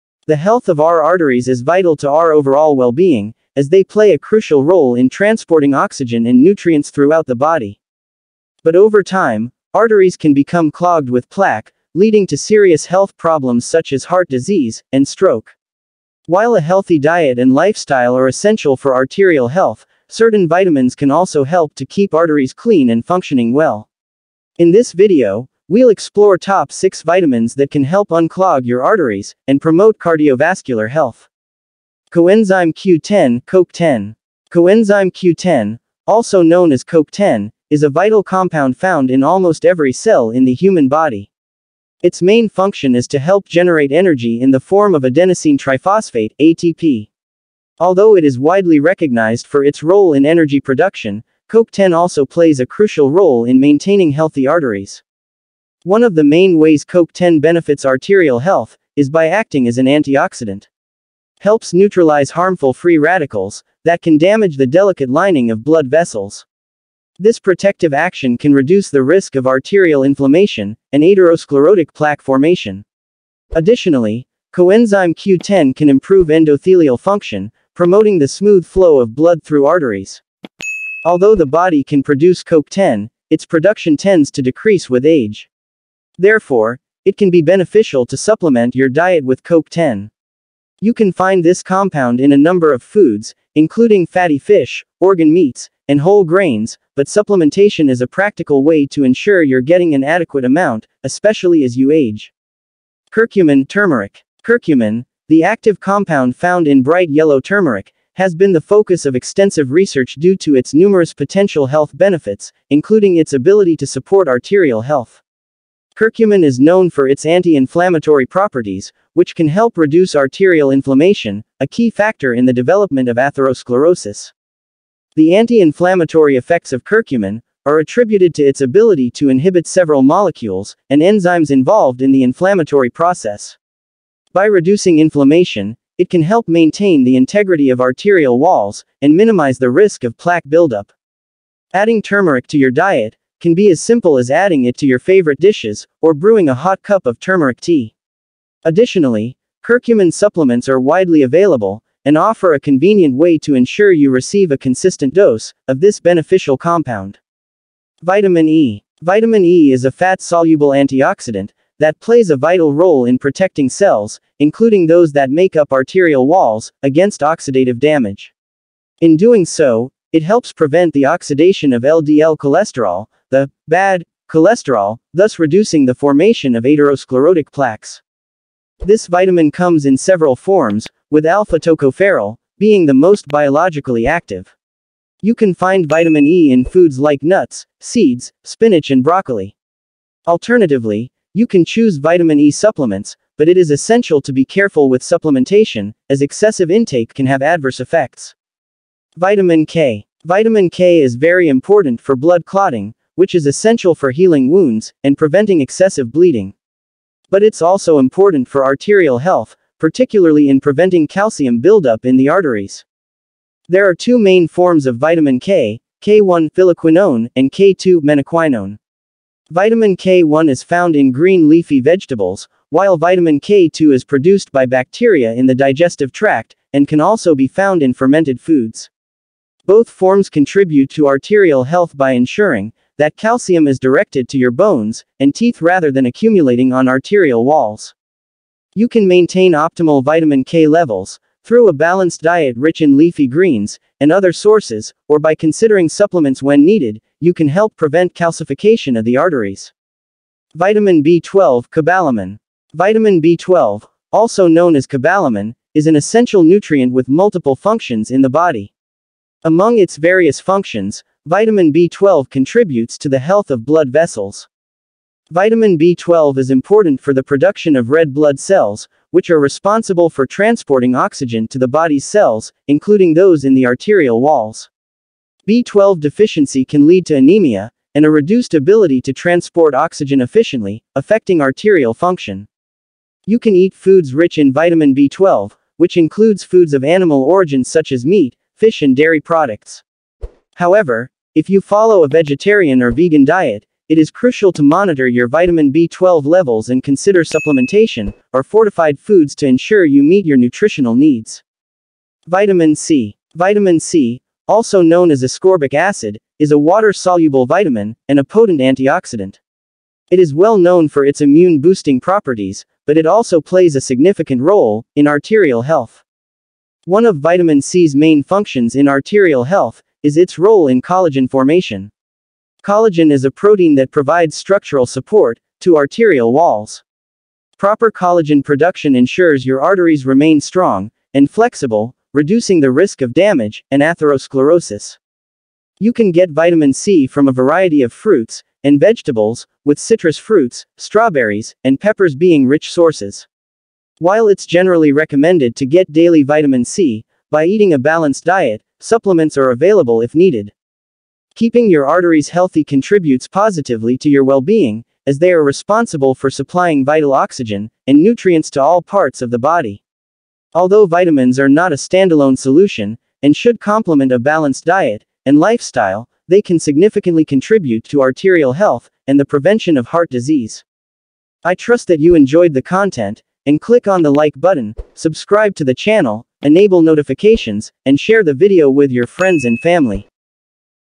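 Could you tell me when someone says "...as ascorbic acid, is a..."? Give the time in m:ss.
5:05.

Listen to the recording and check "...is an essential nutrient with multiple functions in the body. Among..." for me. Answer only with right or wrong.
right.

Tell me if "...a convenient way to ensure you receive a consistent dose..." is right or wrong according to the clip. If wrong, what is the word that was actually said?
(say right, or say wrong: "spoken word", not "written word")
right.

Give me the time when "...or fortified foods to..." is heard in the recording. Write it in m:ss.
4:58.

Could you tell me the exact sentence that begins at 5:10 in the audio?
It is well known for its immune-boosting properties, but it also plays a significant role in arterial health.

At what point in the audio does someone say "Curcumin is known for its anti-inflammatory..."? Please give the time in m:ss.
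1:55.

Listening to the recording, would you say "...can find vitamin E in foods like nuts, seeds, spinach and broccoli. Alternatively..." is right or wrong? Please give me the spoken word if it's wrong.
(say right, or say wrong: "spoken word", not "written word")
right.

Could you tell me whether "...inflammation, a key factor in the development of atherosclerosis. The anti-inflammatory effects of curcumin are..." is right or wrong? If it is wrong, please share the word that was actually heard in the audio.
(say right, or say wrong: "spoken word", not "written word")
right.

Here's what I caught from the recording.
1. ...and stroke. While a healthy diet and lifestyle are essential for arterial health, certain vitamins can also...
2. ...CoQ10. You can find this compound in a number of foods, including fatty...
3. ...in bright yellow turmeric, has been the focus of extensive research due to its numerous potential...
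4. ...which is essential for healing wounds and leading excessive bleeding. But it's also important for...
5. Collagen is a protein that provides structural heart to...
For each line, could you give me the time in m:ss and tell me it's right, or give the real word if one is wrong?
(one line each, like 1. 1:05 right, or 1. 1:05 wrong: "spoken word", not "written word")
1. 0:14 right
2. 1:29 right
3. 1:46 right
4. 3:23 wrong: "preventing", not "leading"
5. 5:22 wrong: "support", not "heart".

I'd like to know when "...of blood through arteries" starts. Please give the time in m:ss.
1:19.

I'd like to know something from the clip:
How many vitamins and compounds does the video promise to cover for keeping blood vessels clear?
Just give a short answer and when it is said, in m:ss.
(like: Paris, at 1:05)
6, at 0:26.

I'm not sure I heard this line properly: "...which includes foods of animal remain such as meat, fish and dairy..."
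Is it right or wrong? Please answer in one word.
wrong.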